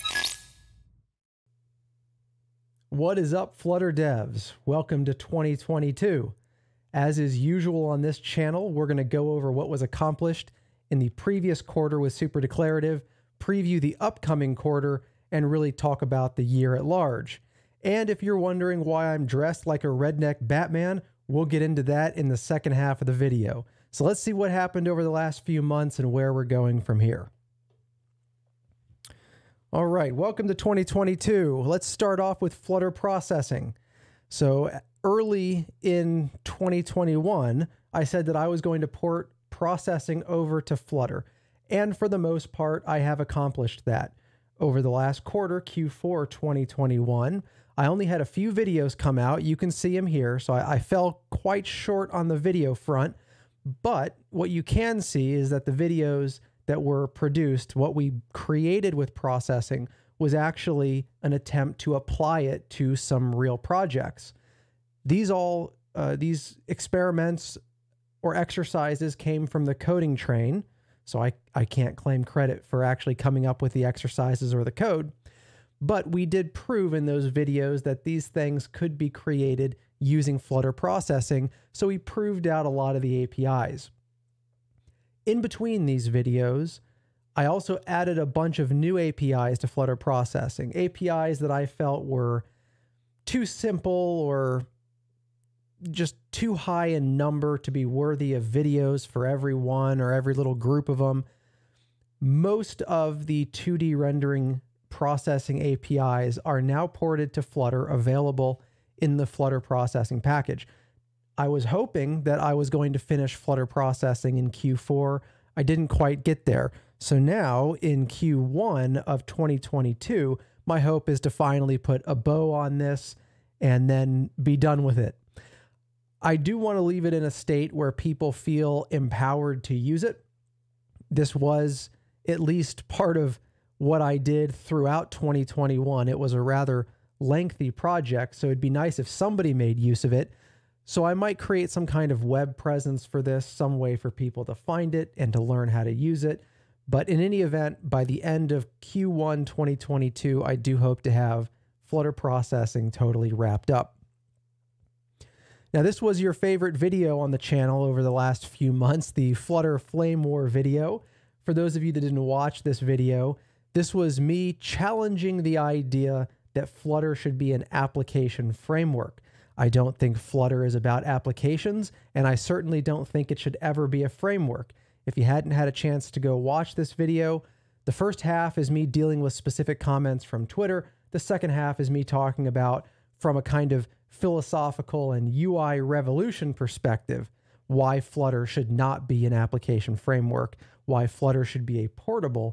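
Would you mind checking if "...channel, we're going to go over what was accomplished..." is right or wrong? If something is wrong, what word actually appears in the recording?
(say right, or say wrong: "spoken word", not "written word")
right.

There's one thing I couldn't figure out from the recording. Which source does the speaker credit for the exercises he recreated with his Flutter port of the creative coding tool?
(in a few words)
The Coding Train.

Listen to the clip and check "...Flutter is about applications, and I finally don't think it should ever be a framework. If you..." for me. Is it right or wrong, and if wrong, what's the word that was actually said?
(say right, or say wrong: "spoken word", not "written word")
wrong: "certainly", not "finally".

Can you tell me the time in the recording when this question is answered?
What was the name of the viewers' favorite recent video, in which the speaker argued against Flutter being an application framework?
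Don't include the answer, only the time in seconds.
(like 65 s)
159 s.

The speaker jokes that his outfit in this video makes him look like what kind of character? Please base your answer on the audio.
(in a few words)
Redneck Batman.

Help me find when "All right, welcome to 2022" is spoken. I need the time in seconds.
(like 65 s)
29 s.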